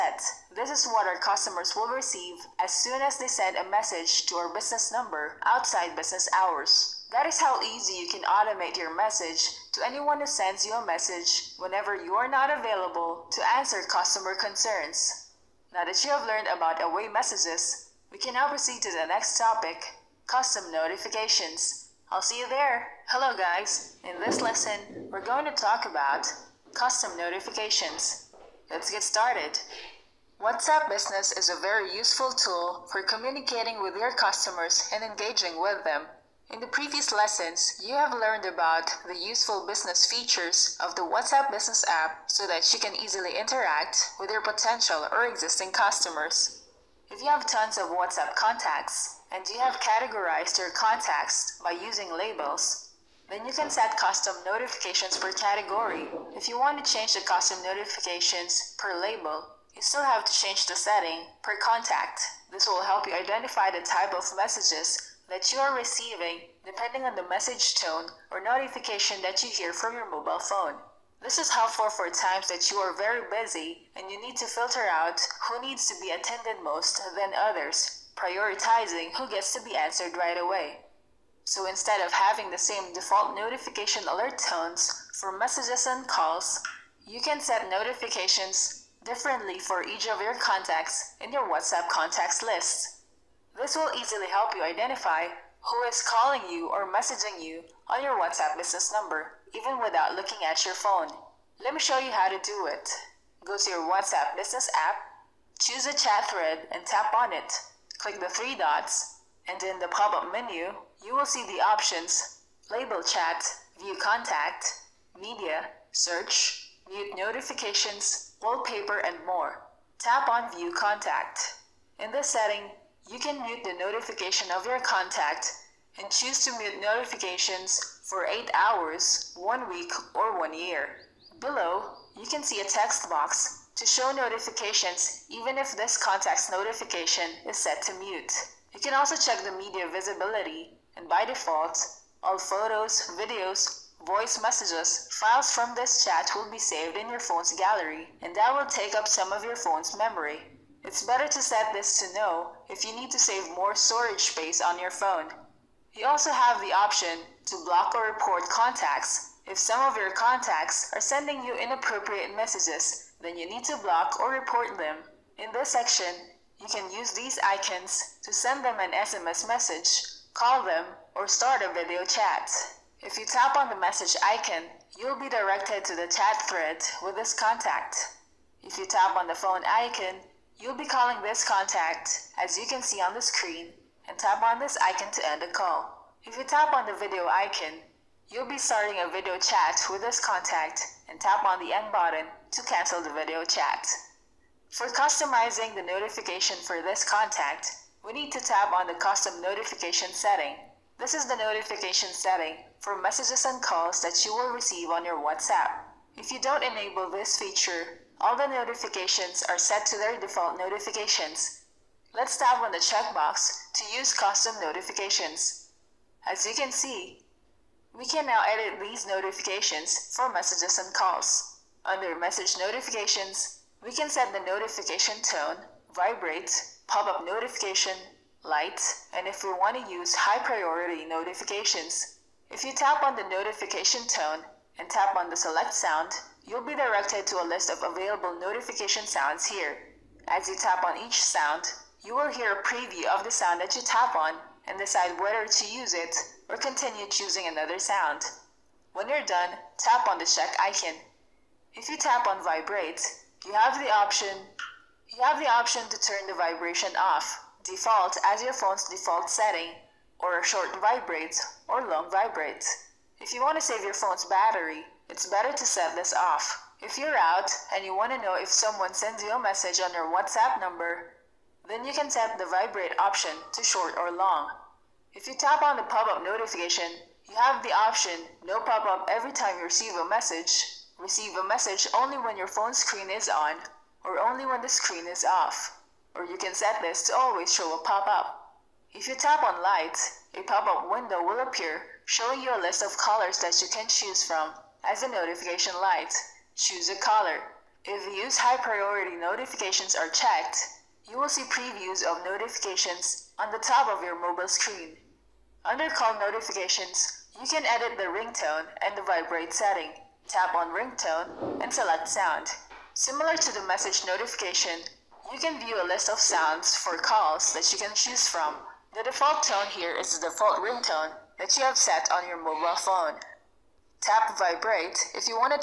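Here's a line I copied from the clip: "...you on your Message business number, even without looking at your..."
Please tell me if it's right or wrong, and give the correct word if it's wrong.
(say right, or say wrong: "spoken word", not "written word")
wrong: "WhatsApp", not "Message".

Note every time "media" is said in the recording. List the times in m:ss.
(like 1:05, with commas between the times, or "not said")
1:55, 2:19.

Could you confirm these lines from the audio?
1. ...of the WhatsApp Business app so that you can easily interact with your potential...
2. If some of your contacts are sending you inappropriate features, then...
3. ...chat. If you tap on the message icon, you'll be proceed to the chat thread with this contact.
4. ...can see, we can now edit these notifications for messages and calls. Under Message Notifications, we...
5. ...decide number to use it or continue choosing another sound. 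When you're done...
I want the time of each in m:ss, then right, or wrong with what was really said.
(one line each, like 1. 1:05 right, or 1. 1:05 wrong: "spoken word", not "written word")
1. 0:40 right
2. 2:39 wrong: "messages", not "features"
3. 2:52 wrong: "directed", not "proceed"
4. 3:36 right
5. 4:04 wrong: "whether", not "number".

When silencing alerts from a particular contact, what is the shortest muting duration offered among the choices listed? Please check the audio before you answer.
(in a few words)
8 hours.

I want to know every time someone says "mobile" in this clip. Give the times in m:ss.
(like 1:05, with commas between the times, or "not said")
1:10, 5:04, 5:22.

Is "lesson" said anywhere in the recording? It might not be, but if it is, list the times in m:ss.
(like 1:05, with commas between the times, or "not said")
0:24, 0:37.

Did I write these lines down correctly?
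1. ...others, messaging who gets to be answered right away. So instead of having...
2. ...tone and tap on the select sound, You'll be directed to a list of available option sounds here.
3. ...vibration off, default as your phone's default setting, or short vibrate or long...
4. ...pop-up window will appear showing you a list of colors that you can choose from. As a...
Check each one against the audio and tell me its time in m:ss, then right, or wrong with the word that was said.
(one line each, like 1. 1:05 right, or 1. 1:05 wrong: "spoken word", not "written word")
1. 1:17 wrong: "prioritizing", not "messaging"
2. 3:54 wrong: "notification", not "option"
3. 4:16 right
4. 4:50 right.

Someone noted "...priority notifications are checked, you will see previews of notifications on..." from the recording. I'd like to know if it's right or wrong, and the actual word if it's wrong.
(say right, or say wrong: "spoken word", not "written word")
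right.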